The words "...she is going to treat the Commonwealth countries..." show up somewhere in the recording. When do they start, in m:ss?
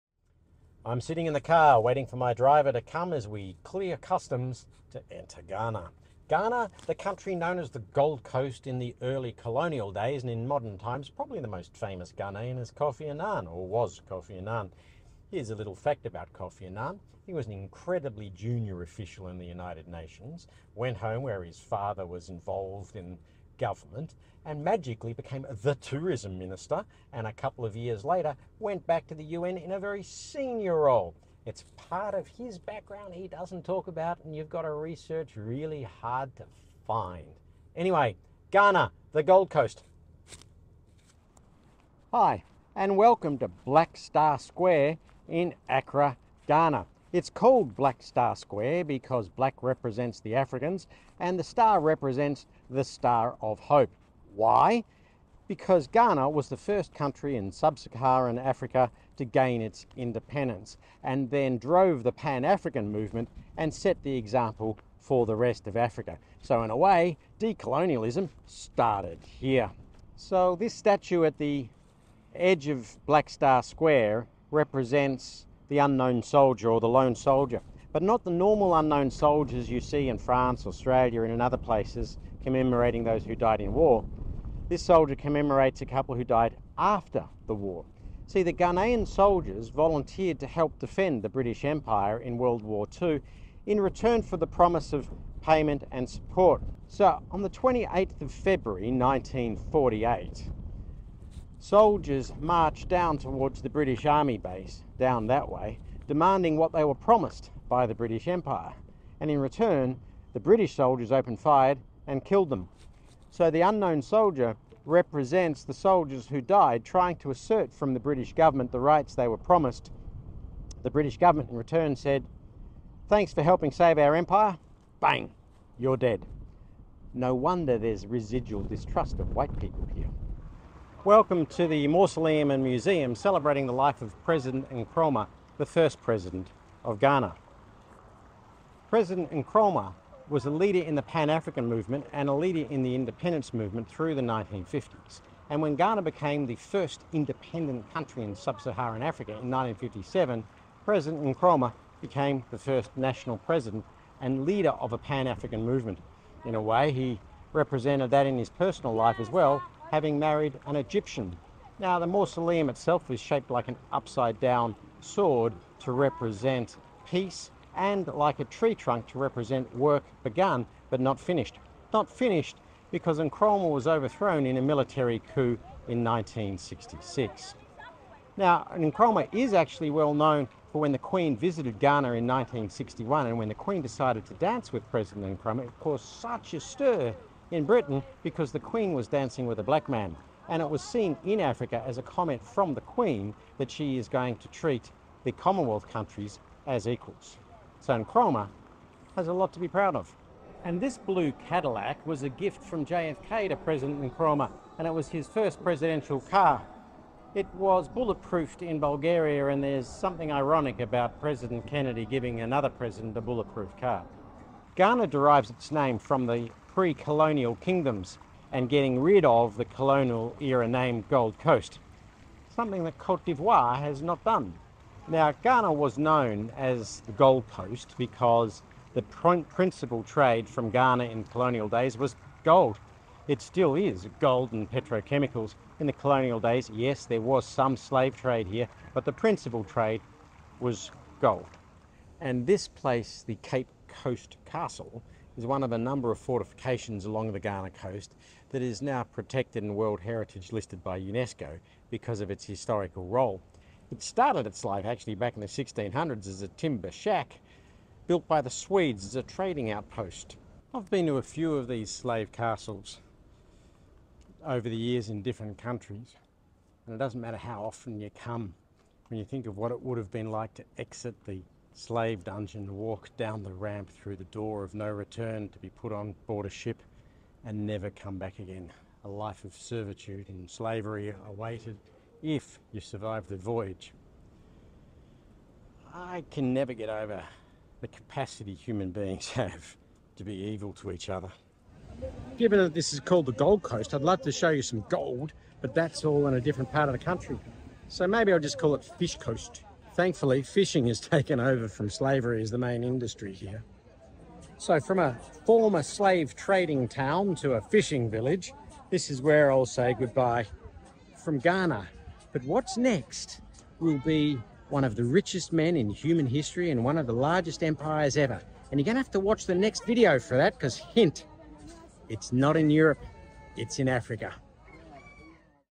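3:13.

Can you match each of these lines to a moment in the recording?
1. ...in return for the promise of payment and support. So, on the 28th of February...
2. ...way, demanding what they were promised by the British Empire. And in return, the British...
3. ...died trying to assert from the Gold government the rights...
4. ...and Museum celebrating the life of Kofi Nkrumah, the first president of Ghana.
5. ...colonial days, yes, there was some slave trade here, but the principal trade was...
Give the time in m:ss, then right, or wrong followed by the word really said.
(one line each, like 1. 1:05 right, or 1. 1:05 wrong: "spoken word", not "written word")
1. 1:33 right
2. 1:45 right
3. 1:56 wrong: "British", not "Gold"
4. 2:12 wrong: "President", not "Kofi"
5. 3:55 right.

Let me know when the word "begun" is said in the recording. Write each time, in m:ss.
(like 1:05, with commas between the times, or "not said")
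2:50.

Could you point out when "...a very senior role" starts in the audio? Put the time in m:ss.
0:29.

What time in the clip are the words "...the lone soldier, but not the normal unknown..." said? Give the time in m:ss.
1:16.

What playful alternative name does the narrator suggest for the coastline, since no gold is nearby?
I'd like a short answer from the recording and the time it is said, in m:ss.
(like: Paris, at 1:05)
Fish Coast, at 4:58.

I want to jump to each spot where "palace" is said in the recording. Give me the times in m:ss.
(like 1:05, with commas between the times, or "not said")
not said.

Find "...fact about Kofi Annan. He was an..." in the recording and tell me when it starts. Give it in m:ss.
0:15.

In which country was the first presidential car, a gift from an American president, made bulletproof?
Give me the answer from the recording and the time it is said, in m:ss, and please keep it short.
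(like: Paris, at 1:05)
Bulgaria, at 3:28.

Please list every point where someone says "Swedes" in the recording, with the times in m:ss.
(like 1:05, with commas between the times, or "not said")
4:18.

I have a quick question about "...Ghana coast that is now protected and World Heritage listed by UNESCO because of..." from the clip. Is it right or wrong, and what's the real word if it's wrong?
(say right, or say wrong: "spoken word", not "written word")
right.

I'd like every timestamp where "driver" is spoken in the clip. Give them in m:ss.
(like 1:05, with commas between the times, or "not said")
0:02.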